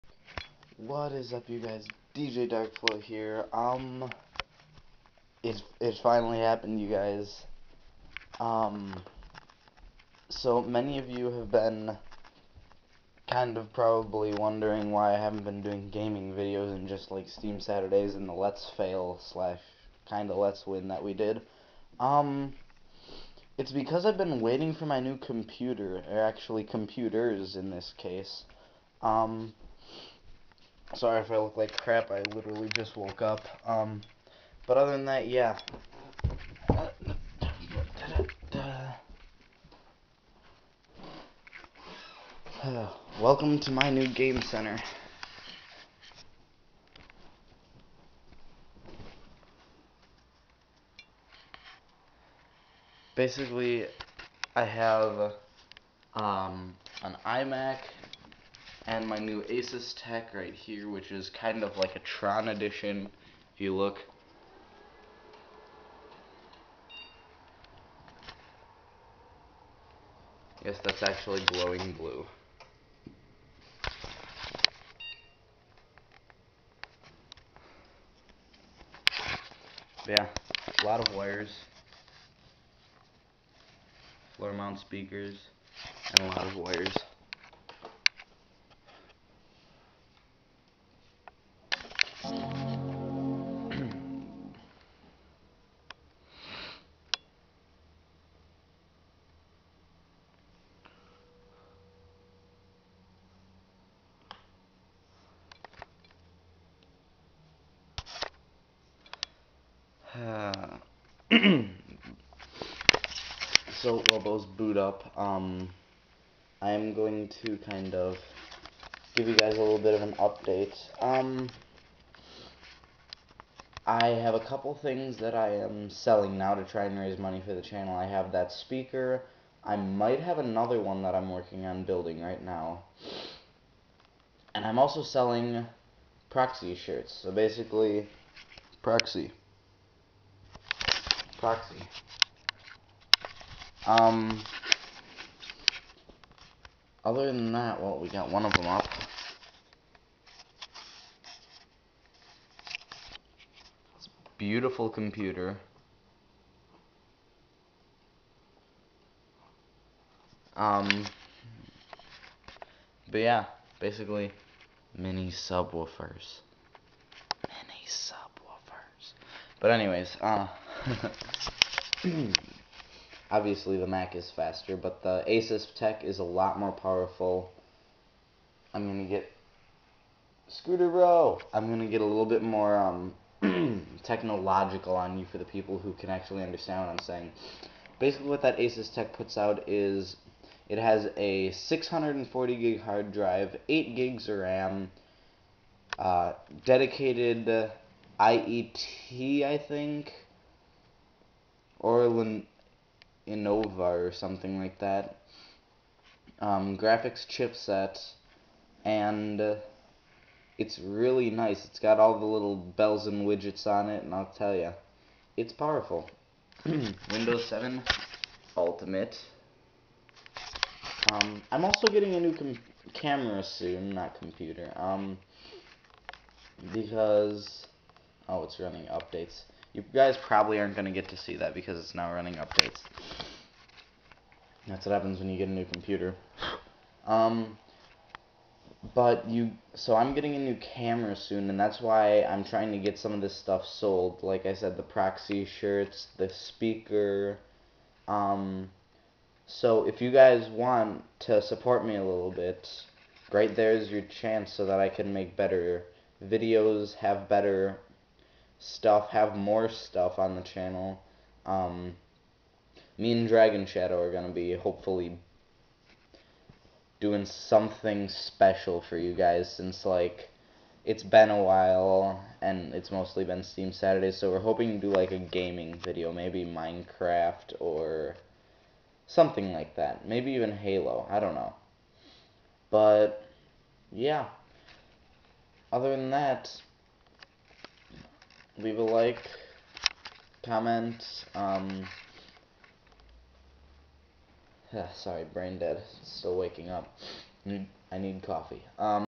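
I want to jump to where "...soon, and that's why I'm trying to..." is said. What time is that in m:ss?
4:01.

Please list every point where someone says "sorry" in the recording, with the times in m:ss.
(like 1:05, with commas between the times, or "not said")
0:30, 4:54.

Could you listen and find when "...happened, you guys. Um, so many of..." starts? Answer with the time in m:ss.
0:06.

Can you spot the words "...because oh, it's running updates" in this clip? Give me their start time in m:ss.
3:46.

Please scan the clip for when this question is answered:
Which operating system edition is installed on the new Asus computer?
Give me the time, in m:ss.
3:37.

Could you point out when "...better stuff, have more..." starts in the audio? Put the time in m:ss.
4:17.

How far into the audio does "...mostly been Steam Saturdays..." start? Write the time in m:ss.
4:32.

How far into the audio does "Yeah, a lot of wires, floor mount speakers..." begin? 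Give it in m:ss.
1:20.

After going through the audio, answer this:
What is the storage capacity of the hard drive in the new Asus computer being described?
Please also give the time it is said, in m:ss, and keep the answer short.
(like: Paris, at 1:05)
640 GB, at 3:11.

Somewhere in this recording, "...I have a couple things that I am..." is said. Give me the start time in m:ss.
2:03.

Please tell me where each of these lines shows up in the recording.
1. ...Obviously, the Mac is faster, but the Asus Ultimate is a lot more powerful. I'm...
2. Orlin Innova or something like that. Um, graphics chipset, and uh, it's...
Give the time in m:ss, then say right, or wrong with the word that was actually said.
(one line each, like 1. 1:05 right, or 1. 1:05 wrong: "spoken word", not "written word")
1. 2:53 wrong: "Tech", not "Ultimate"
2. 3:21 right.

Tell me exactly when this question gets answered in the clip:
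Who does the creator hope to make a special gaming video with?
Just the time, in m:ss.
4:23.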